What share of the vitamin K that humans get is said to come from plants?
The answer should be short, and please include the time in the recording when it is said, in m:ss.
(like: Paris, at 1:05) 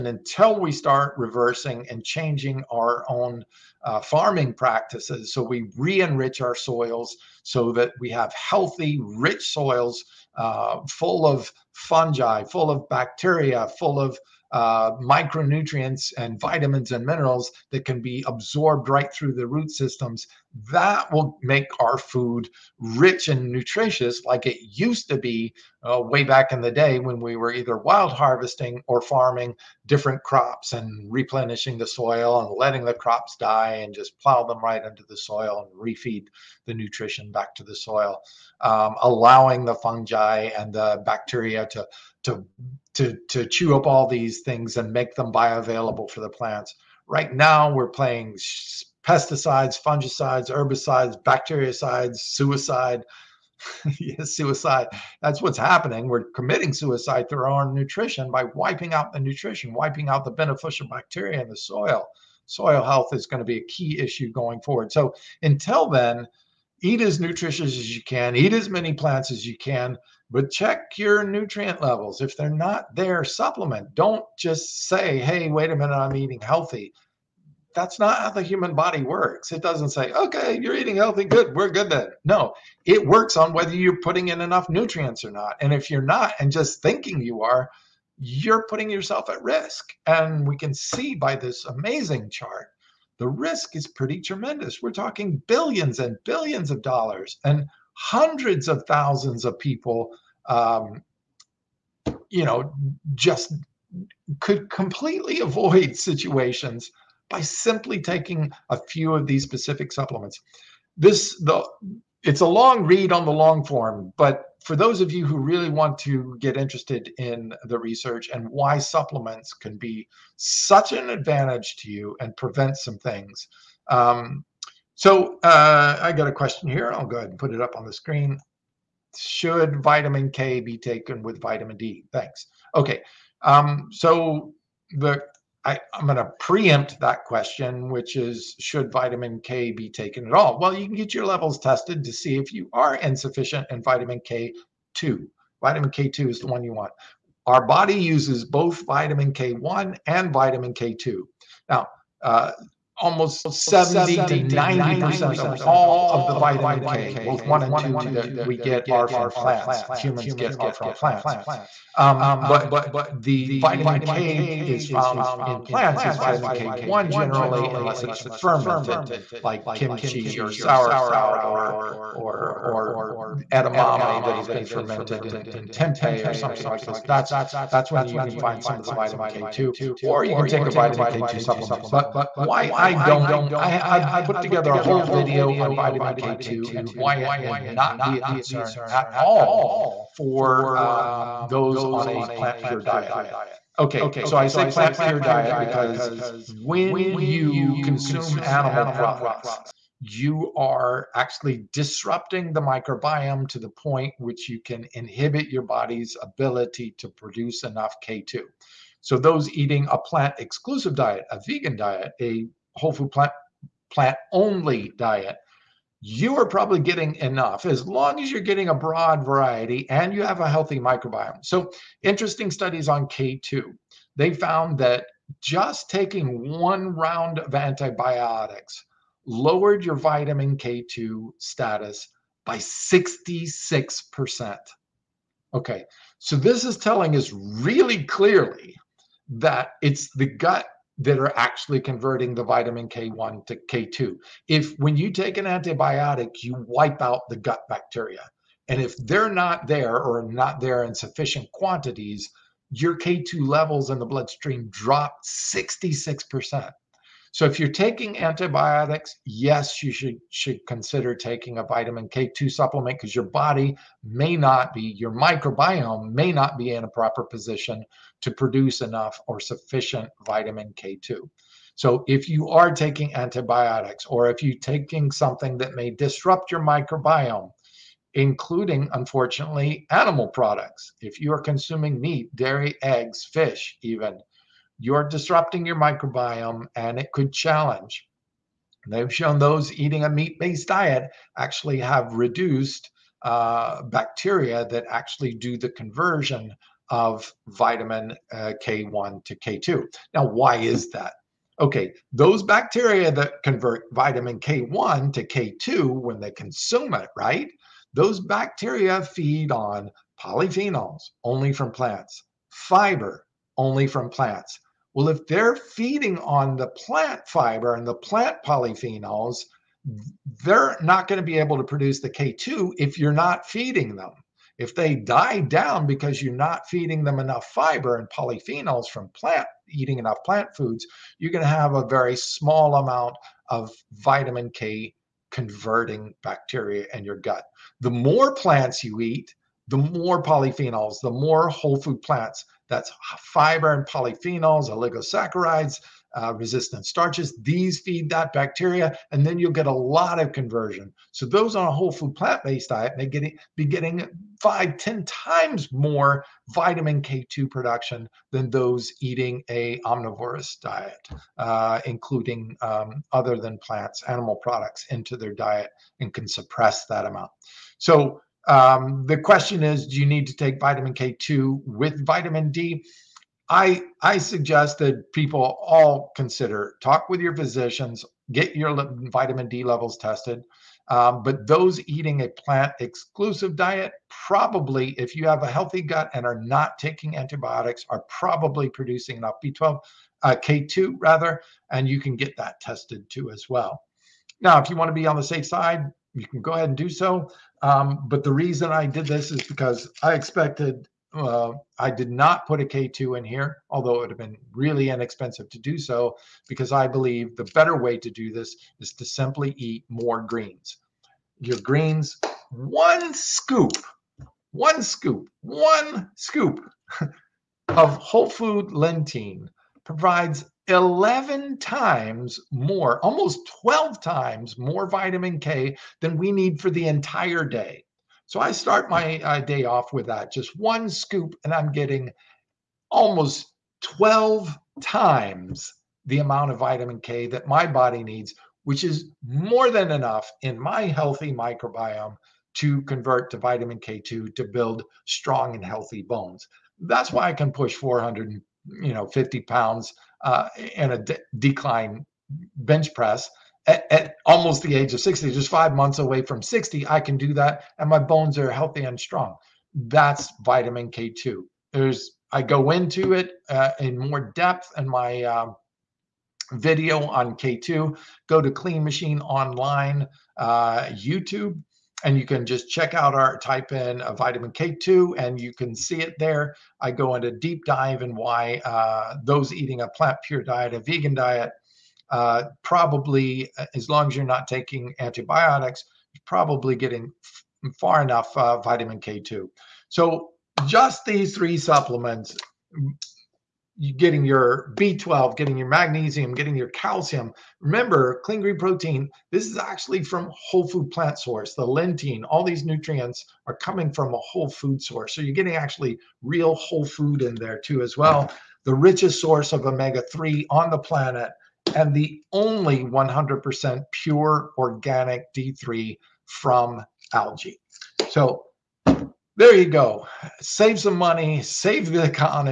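70 to 90%, at 2:33.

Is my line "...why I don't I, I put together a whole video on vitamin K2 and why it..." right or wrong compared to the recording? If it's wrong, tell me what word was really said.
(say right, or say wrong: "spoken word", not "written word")
right.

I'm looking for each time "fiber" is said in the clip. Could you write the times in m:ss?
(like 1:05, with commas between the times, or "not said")
5:12, 5:17, 5:27, 5:43.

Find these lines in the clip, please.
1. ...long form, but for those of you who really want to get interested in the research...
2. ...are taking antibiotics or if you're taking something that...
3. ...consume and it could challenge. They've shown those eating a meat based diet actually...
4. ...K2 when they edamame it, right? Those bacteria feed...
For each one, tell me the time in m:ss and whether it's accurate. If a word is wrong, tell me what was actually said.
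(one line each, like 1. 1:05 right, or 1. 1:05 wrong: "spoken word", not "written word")
1. 1:53 right
2. 4:32 right
3. 4:45 wrong: "microbiome", not "consume"
4. 5:05 wrong: "consume", not "edamame".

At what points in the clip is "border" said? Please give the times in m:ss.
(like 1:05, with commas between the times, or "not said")
not said.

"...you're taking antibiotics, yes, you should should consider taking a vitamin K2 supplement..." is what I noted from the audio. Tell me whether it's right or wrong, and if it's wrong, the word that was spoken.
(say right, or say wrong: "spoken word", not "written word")
right.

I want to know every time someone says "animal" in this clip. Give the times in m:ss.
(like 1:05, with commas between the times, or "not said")
3:18, 4:39, 6:04.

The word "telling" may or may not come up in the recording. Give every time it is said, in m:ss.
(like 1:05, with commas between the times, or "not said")
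3:56.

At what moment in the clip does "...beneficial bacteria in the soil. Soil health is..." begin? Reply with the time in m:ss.
1:00.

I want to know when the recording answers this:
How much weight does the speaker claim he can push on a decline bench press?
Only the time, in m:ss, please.
7:27.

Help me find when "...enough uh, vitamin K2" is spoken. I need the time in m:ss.
8:08.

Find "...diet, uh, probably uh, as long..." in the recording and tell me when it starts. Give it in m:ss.
8:01.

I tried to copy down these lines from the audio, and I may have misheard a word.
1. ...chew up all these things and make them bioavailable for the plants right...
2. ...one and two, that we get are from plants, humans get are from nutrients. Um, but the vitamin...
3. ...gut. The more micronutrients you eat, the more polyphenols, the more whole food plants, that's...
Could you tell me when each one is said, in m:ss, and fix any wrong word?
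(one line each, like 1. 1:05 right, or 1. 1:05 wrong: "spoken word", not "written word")
1. 0:43 right
2. 2:37 wrong: "plants", not "nutrients"
3. 5:37 wrong: "plants", not "micronutrients".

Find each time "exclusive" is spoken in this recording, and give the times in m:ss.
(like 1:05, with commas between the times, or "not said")
3:30, 6:22.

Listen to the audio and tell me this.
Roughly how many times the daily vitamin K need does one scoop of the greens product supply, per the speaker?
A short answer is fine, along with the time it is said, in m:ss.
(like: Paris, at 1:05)
11 times, at 7:00.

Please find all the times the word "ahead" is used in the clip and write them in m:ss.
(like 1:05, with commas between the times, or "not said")
2:07, 6:36.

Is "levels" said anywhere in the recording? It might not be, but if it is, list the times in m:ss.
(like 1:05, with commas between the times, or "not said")
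1:11, 2:21, 4:13, 6:19.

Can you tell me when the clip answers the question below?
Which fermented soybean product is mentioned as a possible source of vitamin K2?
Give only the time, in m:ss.
2:55.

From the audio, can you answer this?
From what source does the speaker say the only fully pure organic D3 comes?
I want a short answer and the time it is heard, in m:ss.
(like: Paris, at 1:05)
algae, at 8:37.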